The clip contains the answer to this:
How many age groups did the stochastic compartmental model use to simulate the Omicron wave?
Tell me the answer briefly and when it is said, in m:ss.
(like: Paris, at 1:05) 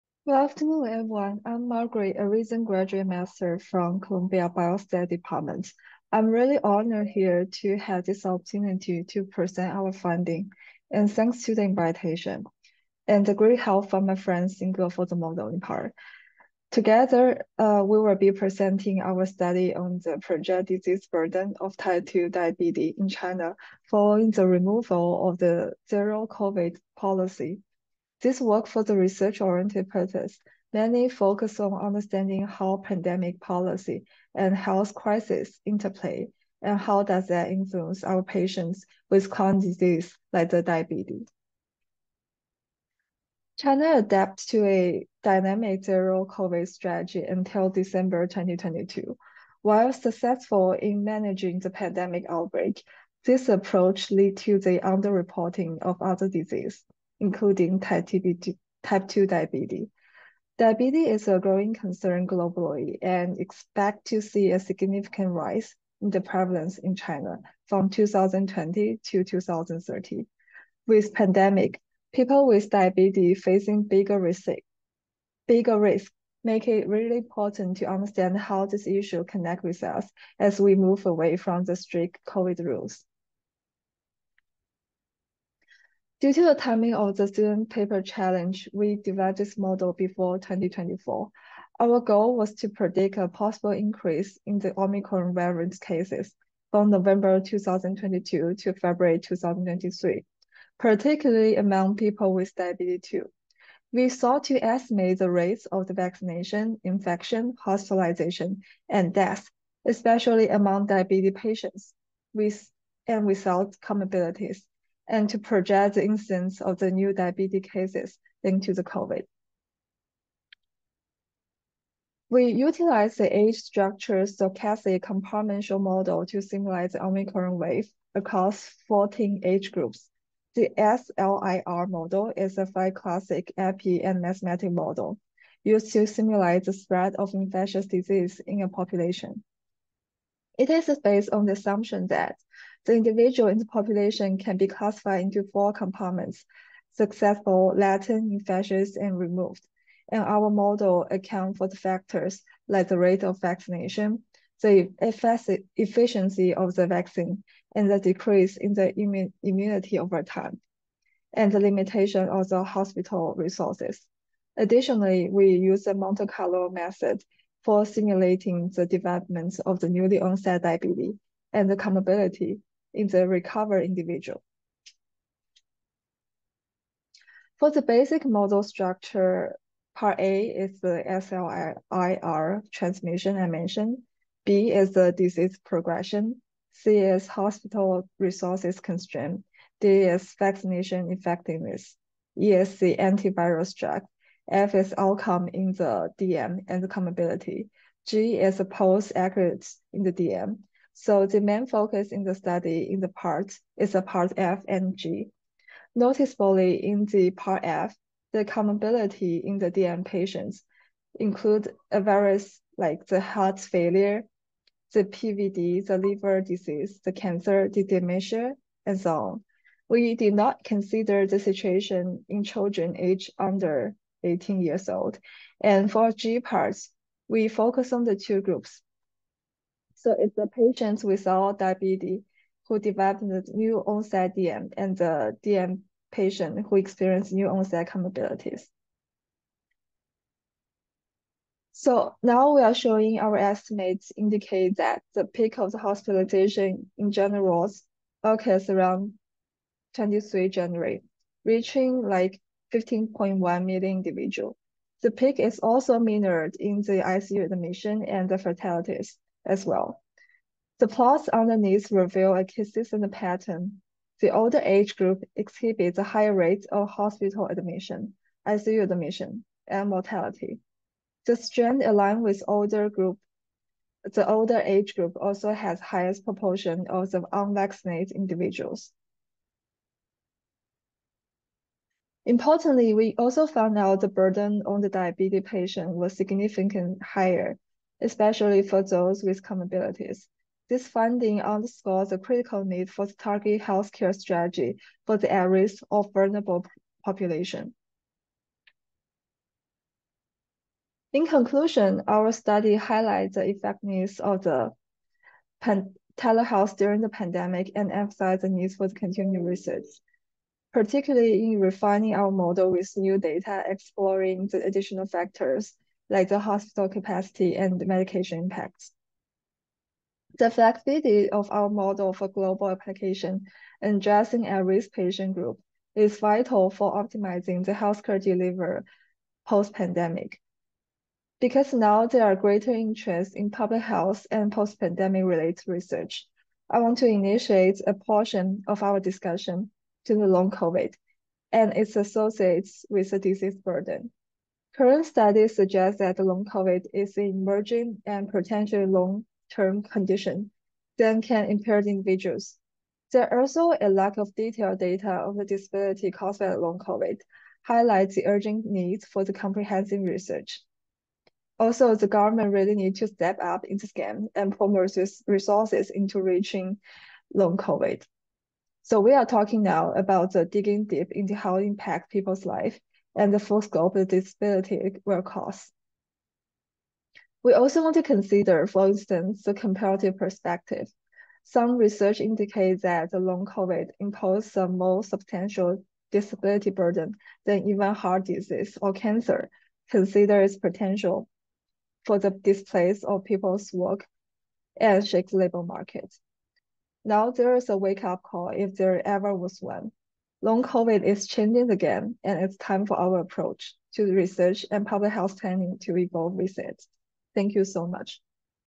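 14, at 2:08.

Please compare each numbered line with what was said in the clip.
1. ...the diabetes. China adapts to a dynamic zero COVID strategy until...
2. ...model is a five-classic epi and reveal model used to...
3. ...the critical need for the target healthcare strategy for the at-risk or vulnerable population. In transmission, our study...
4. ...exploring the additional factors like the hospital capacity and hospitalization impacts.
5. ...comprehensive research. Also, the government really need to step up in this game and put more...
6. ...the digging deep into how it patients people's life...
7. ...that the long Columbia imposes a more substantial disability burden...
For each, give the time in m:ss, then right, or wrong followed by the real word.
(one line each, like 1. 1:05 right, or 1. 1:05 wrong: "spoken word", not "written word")
1. 0:40 right
2. 2:11 wrong: "mathematical", not "reveal"
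3. 4:52 wrong: "conclusion", not "transmission"
4. 5:13 wrong: "medication", not "hospitalization"
5. 5:59 right
6. 6:10 wrong: "impacts", not "patients"
7. 6:22 wrong: "COVID", not "Columbia".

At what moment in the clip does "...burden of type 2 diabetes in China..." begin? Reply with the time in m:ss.
0:21.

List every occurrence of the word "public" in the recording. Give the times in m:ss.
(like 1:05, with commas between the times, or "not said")
5:33, 6:44.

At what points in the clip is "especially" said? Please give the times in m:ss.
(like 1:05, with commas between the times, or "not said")
1:49, 4:48.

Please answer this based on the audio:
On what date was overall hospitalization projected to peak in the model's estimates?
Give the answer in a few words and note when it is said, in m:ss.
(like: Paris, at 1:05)
23 January, at 4:09.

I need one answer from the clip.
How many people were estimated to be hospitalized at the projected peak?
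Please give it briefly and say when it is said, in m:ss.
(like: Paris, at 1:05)
15.1 million, at 4:12.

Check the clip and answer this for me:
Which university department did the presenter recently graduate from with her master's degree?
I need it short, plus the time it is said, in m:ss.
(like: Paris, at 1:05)
Columbia Biostat Department, at 0:03.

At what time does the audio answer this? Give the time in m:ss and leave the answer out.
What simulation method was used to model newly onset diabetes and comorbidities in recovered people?
2:45.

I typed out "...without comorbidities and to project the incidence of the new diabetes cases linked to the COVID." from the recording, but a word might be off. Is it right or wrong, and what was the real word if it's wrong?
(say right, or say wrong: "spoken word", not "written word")
right.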